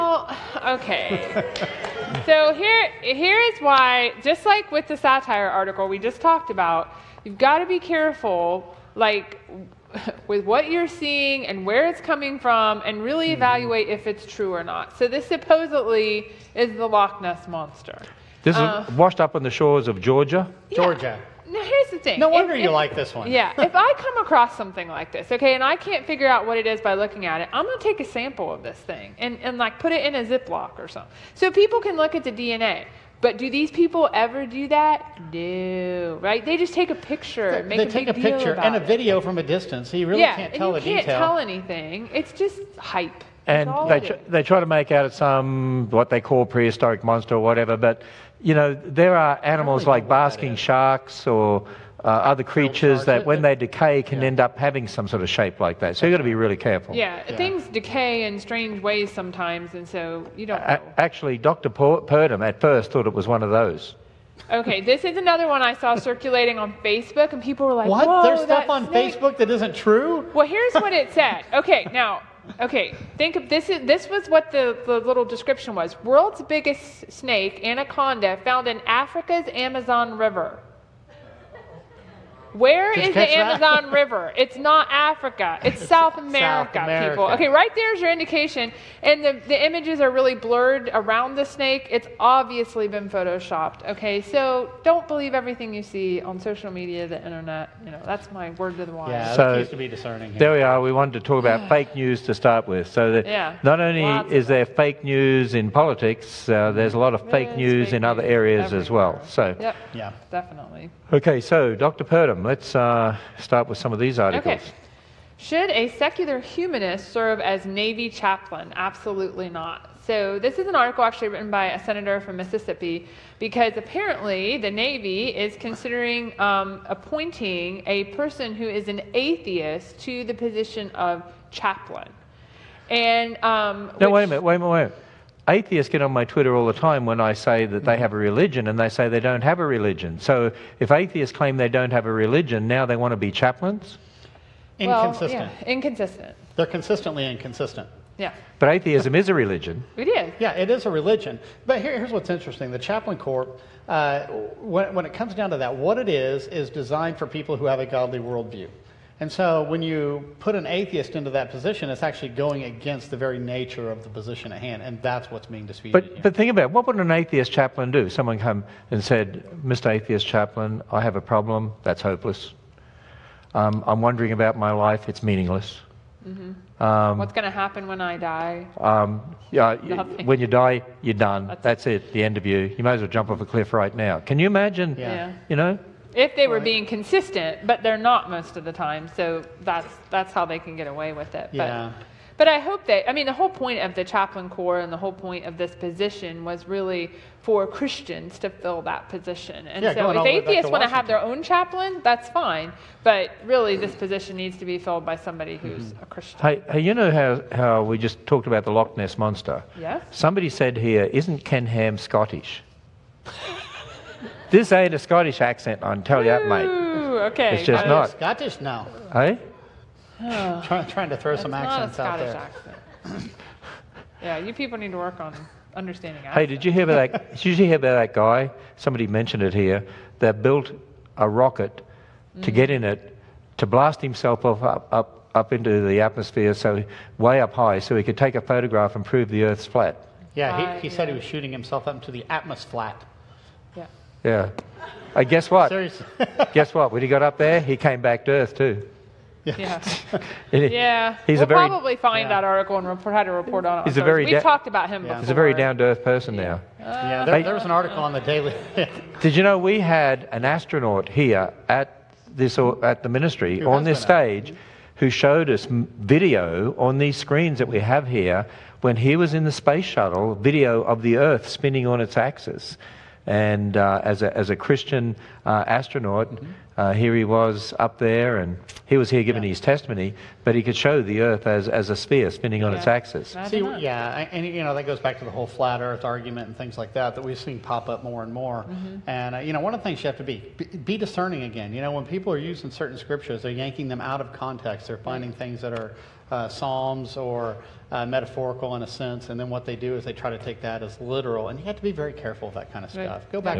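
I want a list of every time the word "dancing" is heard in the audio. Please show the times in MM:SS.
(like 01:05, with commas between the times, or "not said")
not said.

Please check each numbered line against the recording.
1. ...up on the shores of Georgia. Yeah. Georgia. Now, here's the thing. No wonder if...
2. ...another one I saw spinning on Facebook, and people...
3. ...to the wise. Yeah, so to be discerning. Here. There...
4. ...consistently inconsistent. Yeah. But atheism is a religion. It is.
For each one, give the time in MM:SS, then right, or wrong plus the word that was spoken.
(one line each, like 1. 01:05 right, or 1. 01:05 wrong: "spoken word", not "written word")
1. 00:19 right
2. 01:05 wrong: "circulating", not "spinning"
3. 01:38 right
4. 02:26 right.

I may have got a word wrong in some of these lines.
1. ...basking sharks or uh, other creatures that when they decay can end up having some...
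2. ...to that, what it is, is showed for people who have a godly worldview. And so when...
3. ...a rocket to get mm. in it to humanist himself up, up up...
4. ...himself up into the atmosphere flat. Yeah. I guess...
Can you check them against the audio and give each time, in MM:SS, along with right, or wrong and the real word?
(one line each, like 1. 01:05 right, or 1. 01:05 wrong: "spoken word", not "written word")
1. 00:50 right
2. 02:35 wrong: "designed", not "showed"
3. 03:51 wrong: "blast", not "humanist"
4. 04:01 right.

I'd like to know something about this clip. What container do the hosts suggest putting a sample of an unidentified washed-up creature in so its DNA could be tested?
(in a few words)
Ziploc.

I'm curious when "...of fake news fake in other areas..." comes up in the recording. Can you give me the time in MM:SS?
01:47.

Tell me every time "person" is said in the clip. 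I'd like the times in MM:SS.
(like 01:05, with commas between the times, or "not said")
02:08, 04:16.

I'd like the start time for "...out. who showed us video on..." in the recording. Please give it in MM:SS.
04:24.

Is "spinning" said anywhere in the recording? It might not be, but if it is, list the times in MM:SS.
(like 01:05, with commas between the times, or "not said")
04:31, 04:42.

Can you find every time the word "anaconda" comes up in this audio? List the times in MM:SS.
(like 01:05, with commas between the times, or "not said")
01:17.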